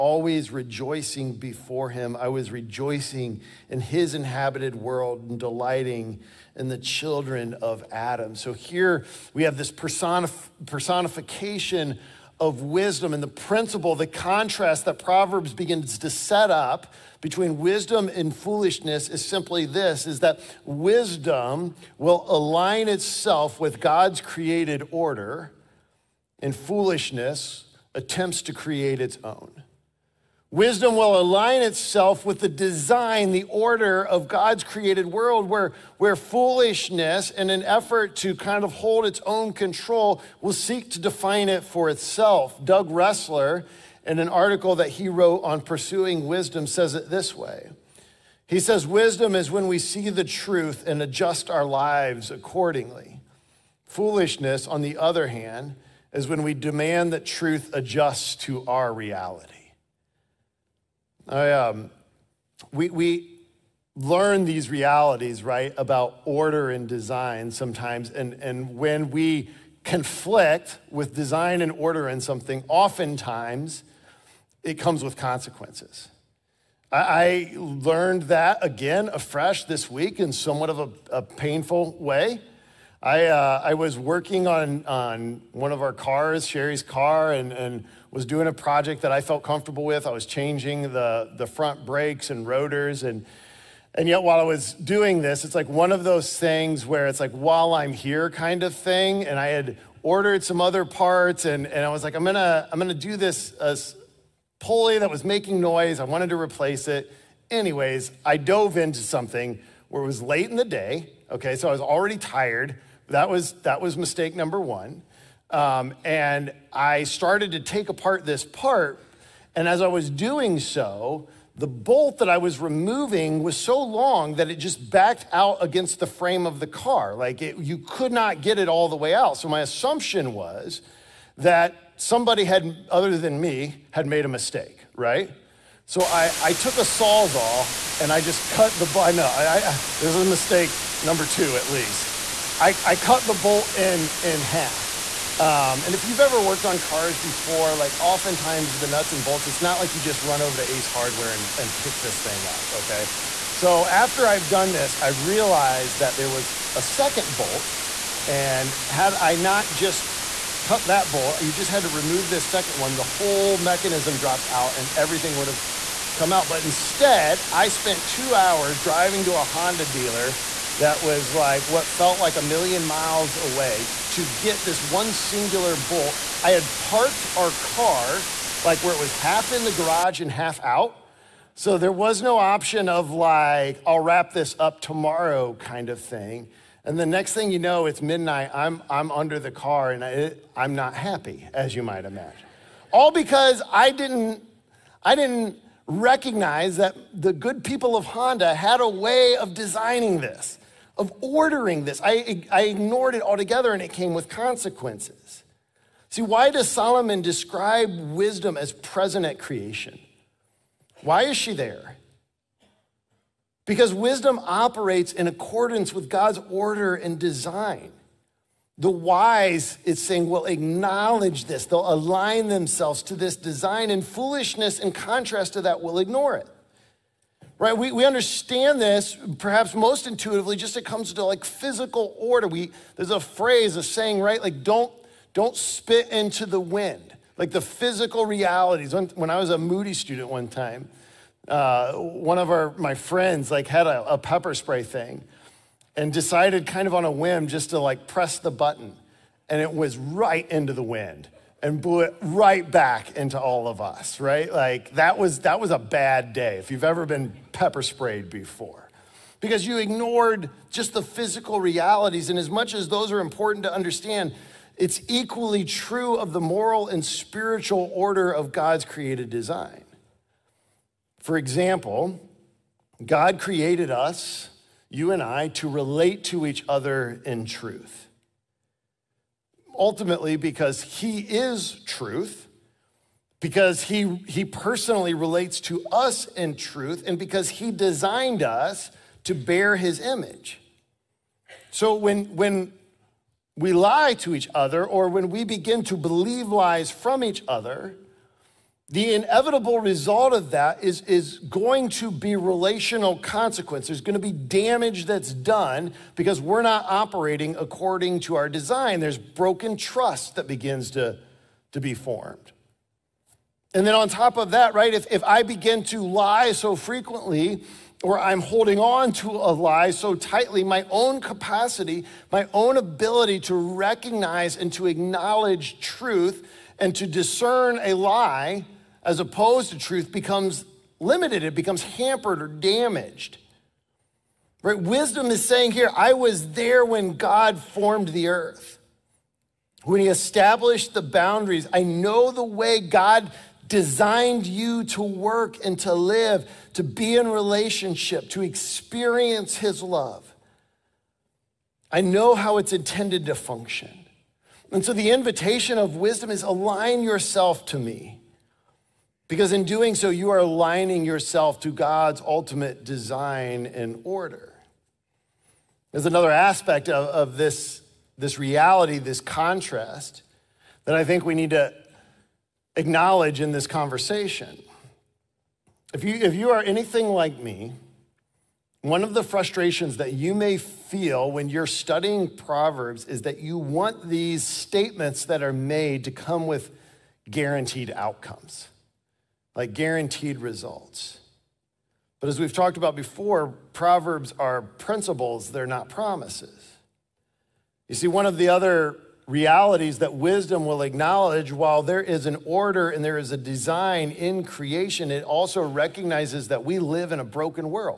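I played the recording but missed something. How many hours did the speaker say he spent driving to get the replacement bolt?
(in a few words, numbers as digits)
2.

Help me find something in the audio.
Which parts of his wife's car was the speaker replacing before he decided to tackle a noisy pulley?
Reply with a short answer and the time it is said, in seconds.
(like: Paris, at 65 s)
front brakes and rotors, at 91 s.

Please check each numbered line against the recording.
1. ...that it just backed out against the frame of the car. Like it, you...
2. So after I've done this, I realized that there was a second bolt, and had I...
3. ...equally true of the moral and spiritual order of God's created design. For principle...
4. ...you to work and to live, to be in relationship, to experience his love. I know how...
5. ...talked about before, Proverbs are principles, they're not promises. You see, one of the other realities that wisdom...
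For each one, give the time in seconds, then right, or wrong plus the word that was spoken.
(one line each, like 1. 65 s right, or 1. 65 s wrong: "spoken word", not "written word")
1. 124 s right
2. 153 s right
3. 265 s wrong: "example", not "principle"
4. 344 s right
5. 392 s right.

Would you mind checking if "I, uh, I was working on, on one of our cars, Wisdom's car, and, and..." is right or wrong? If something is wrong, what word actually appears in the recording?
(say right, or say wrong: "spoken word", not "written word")
wrong: "Sherry", not "Wisdom".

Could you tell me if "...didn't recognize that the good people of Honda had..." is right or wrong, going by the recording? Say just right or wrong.
right.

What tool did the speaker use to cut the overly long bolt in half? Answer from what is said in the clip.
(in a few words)
Sawzall.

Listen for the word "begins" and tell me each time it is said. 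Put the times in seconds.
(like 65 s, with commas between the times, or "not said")
15 s, 295 s, 310 s, 315 s.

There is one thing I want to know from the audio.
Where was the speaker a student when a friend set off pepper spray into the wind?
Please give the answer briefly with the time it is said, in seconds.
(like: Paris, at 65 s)
Moody, at 239 s.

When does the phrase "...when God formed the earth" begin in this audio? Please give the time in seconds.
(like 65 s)
336 s.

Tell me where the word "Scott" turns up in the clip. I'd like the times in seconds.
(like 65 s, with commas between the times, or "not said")
not said.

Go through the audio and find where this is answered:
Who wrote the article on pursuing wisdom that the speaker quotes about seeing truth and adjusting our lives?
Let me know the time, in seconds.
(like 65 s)
42 s.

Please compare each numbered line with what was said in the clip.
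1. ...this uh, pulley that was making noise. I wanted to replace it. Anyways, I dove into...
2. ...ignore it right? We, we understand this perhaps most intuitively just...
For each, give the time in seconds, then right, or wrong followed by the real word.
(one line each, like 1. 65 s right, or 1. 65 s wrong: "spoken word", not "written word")
1. 103 s right
2. 225 s right.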